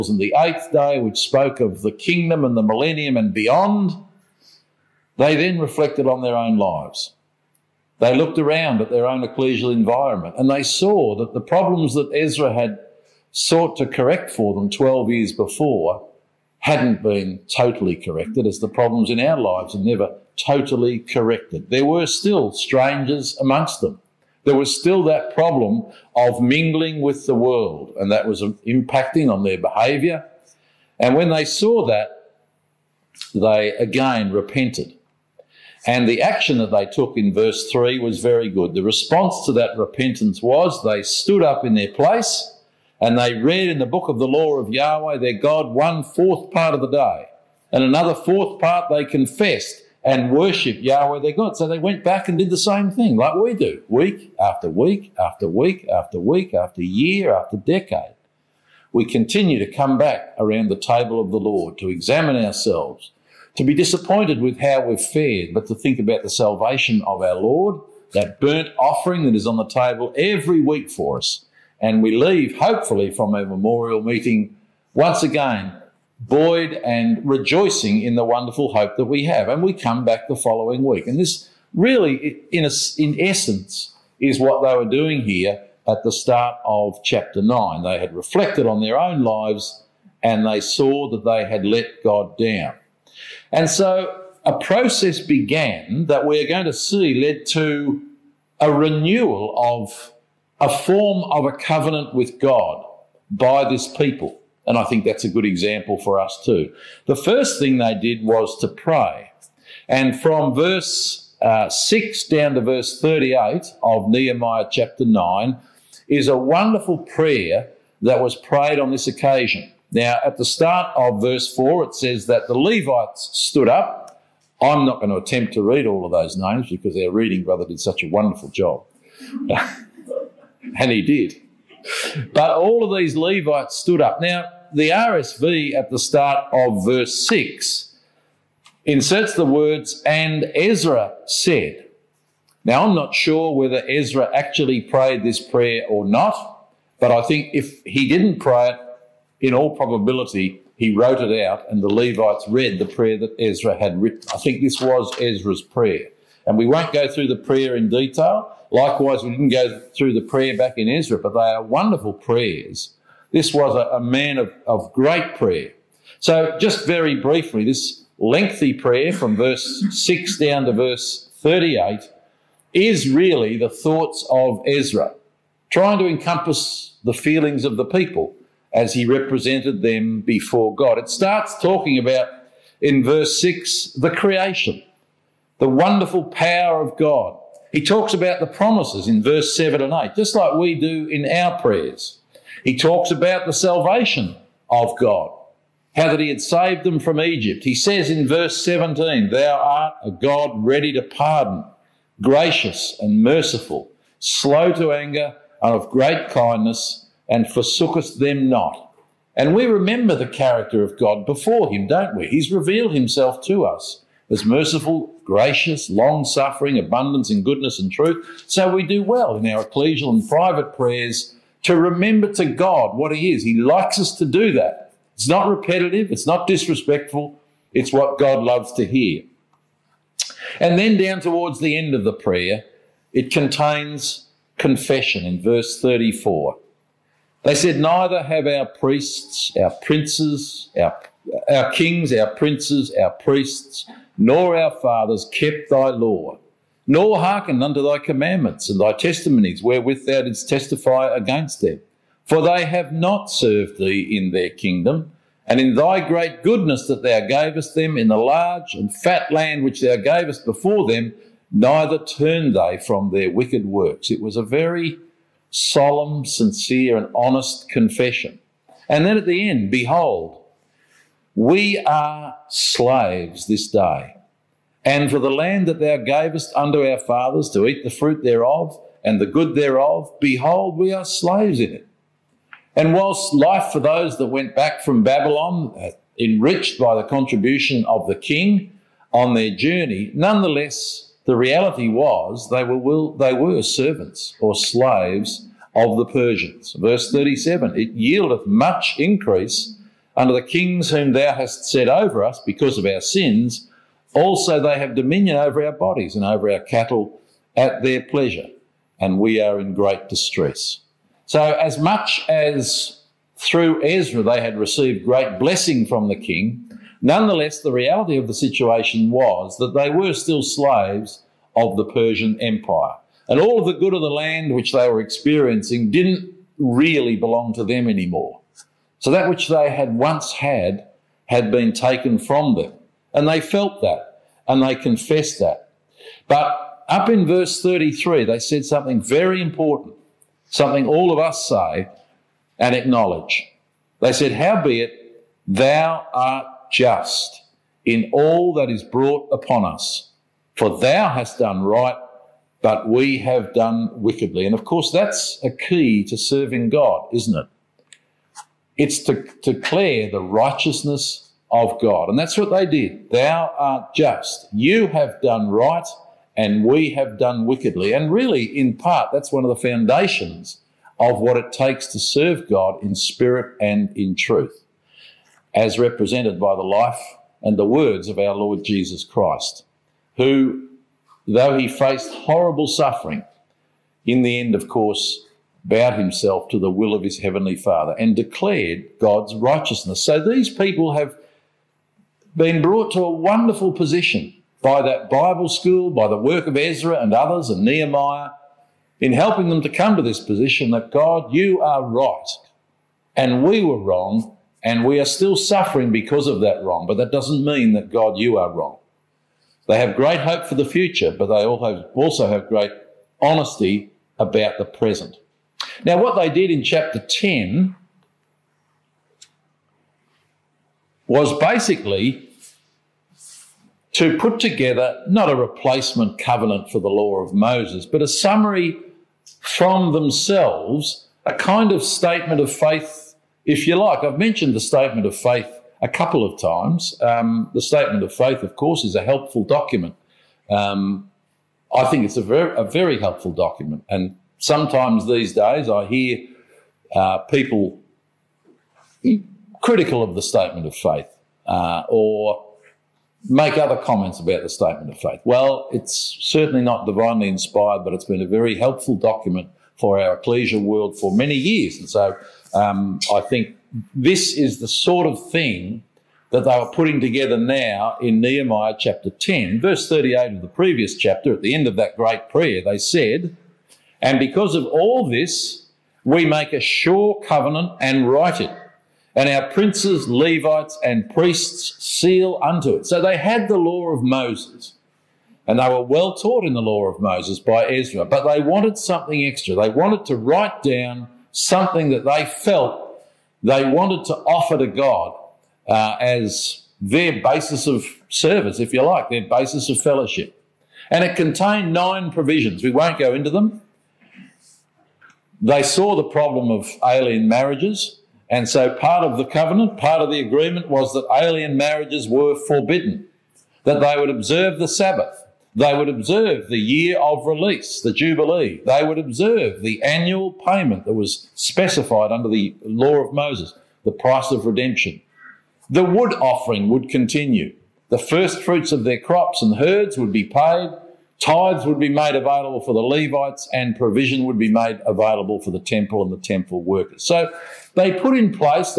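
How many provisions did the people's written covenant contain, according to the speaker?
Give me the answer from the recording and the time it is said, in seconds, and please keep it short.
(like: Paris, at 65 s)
9, at 501 s.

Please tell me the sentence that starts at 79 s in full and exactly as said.
And we come back the following week.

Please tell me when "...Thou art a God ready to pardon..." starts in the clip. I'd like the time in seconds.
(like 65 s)
199 s.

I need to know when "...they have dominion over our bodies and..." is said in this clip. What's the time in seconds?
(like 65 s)
304 s.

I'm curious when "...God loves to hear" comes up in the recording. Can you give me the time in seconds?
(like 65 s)
228 s.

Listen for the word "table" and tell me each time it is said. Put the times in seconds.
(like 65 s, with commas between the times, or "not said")
60 s, 69 s.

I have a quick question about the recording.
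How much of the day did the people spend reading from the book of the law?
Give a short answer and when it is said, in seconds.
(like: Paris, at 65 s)
one fourth part, at 45 s.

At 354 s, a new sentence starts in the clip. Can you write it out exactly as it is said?
And of course, that's a key to serving God, isn't it?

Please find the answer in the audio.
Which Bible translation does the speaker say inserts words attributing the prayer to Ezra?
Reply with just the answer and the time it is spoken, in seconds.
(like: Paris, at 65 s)
RSV, at 134 s.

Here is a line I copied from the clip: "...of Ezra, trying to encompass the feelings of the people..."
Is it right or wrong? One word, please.
right.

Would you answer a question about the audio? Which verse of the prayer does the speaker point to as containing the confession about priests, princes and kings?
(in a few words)
34.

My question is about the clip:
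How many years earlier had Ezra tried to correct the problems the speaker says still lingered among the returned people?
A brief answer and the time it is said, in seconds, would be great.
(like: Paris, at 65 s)
12, at 14 s.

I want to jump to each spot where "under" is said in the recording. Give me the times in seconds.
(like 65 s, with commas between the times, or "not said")
300 s, 522 s.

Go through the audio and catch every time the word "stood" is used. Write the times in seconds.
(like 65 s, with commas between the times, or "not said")
41 s, 123 s, 133 s.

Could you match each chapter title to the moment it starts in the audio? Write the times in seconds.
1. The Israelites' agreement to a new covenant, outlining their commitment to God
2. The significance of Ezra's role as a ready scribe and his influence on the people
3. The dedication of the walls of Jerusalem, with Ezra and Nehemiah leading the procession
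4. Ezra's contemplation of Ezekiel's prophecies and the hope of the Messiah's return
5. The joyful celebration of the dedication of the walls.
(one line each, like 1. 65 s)
1. 40 s
2. 130 s
3. 220 s
4. 310 s
5. 370 s.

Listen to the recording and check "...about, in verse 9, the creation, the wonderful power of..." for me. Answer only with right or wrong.
wrong.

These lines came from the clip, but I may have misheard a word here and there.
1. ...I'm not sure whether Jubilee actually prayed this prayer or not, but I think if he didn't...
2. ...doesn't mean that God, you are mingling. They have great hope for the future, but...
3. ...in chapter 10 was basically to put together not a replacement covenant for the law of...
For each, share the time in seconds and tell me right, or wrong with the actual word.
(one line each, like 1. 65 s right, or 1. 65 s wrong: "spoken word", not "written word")
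1. 142 s wrong: "Ezra", not "Jubilee"
2. 407 s wrong: "wrong", not "mingling"
3. 416 s right.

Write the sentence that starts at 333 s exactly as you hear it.
And they felt that and they confessed that.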